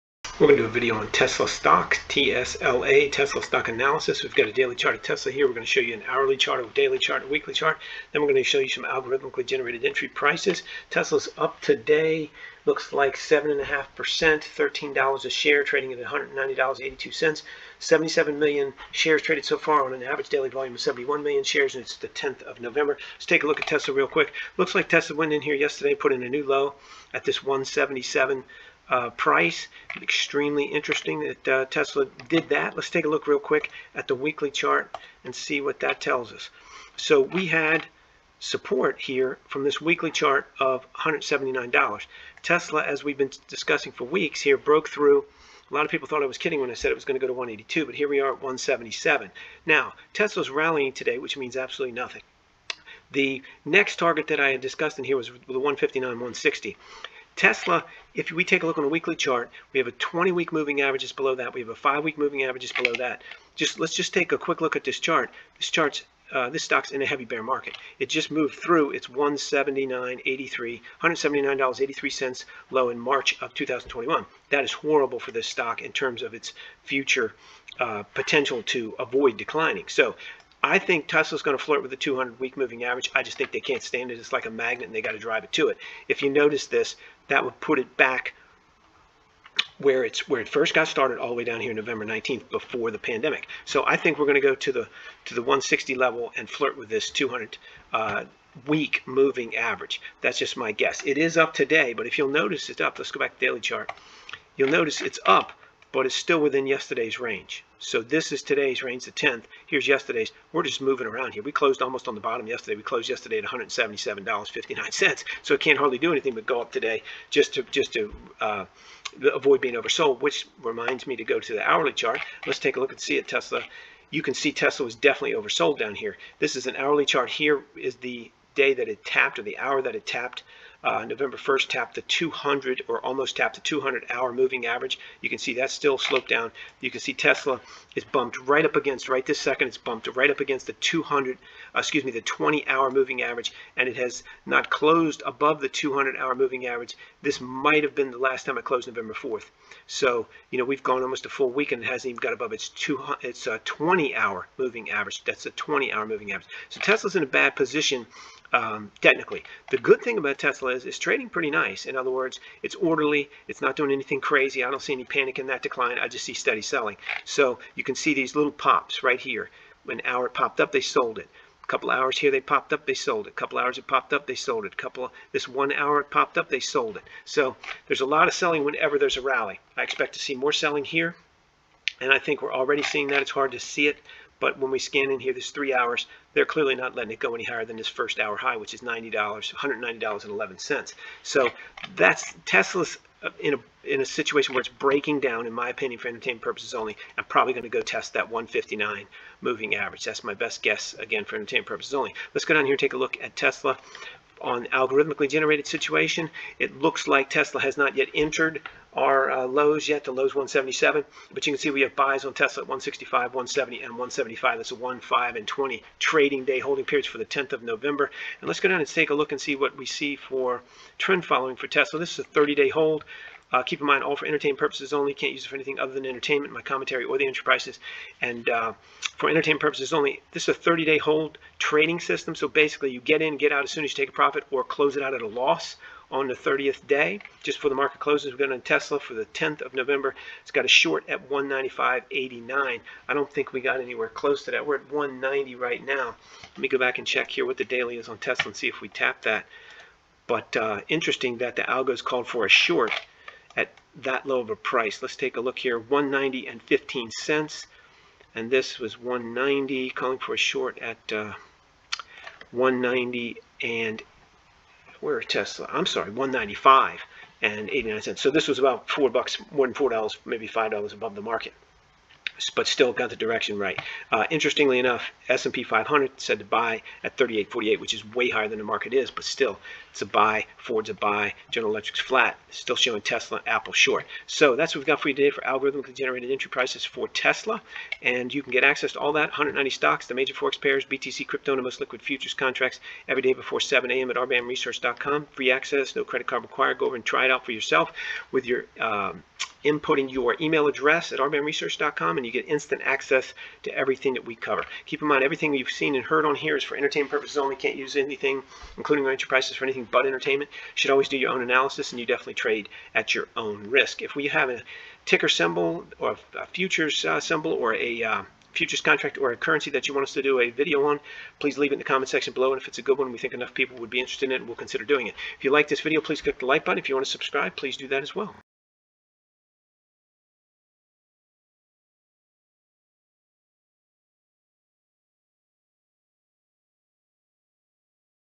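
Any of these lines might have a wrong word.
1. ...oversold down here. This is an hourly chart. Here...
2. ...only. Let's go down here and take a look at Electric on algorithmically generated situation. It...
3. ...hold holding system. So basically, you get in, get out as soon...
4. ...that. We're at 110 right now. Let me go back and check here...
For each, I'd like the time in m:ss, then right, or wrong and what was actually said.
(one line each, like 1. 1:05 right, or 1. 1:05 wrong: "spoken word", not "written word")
1. 2:05 right
2. 3:21 wrong: "Tesla", not "Electric"
3. 3:50 wrong: "trading", not "holding"
4. 4:04 wrong: "190", not "110".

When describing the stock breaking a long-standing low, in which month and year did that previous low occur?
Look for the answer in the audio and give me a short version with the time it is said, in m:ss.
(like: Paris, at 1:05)
March 2021, at 1:12.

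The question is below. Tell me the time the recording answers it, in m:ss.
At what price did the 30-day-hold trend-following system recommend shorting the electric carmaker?
4:01.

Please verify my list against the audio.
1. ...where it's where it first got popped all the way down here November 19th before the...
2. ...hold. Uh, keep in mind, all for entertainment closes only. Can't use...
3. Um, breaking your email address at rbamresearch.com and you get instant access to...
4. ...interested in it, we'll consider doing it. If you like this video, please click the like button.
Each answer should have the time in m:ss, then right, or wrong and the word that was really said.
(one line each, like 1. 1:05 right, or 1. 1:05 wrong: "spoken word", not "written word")
1. 1:29 wrong: "started", not "popped"
2. 3:42 wrong: "purposes", not "closes"
3. 4:58 wrong: "inputting", not "breaking"
4. 5:23 right.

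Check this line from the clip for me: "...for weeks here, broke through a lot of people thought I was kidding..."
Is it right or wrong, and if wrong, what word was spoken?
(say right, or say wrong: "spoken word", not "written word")
right.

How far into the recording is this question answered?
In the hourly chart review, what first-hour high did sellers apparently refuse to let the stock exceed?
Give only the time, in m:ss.
3:09.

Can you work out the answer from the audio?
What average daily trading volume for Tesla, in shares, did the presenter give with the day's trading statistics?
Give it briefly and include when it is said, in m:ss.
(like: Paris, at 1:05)
71 million, at 0:20.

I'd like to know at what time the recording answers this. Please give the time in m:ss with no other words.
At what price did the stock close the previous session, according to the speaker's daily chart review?
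1:53.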